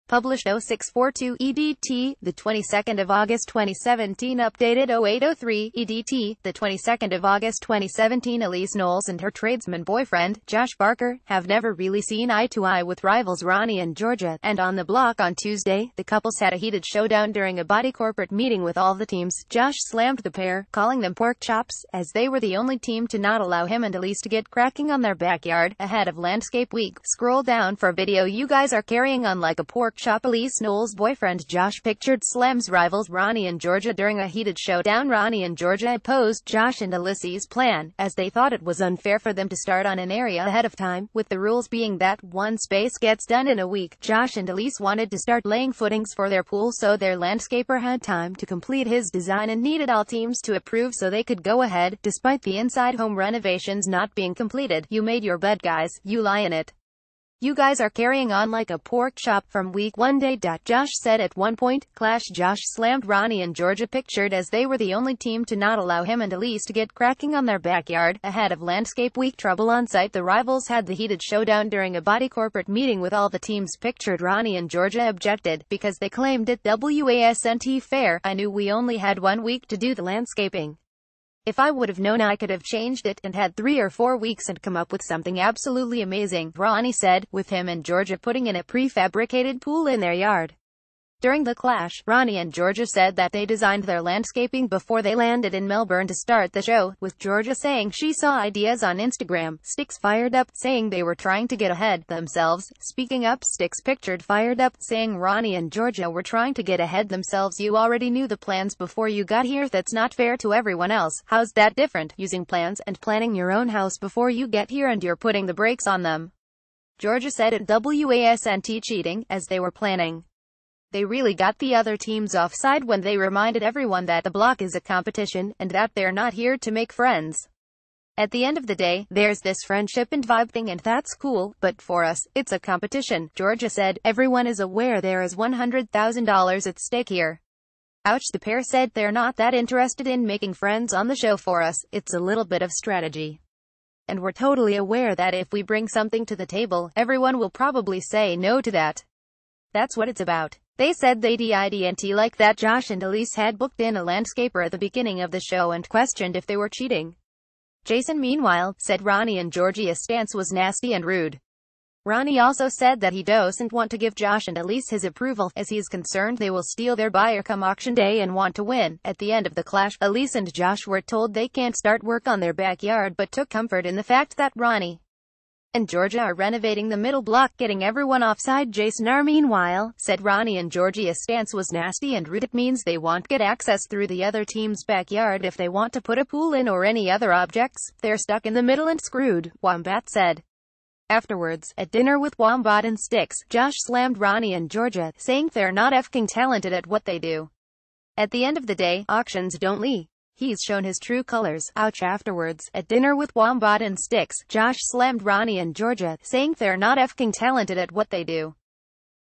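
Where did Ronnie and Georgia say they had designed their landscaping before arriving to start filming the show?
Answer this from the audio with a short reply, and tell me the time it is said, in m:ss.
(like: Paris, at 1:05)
Melbourne, at 1:35.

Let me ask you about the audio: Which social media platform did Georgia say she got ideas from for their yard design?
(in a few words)
Instagram.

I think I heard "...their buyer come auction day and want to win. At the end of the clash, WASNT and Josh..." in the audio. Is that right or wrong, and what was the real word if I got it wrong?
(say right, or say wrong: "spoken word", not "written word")
wrong: "Elyse", not "WASNT".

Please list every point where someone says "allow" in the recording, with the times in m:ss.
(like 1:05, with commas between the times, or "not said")
0:23, 1:05.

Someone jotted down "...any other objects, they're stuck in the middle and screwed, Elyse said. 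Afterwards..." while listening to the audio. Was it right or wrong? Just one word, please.
wrong.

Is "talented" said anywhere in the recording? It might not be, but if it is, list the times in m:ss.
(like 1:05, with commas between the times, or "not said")
3:16, 3:27.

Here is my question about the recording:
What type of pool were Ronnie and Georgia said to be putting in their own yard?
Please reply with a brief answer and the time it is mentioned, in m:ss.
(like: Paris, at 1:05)
prefabricated pool, at 1:28.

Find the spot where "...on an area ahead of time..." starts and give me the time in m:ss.
0:39.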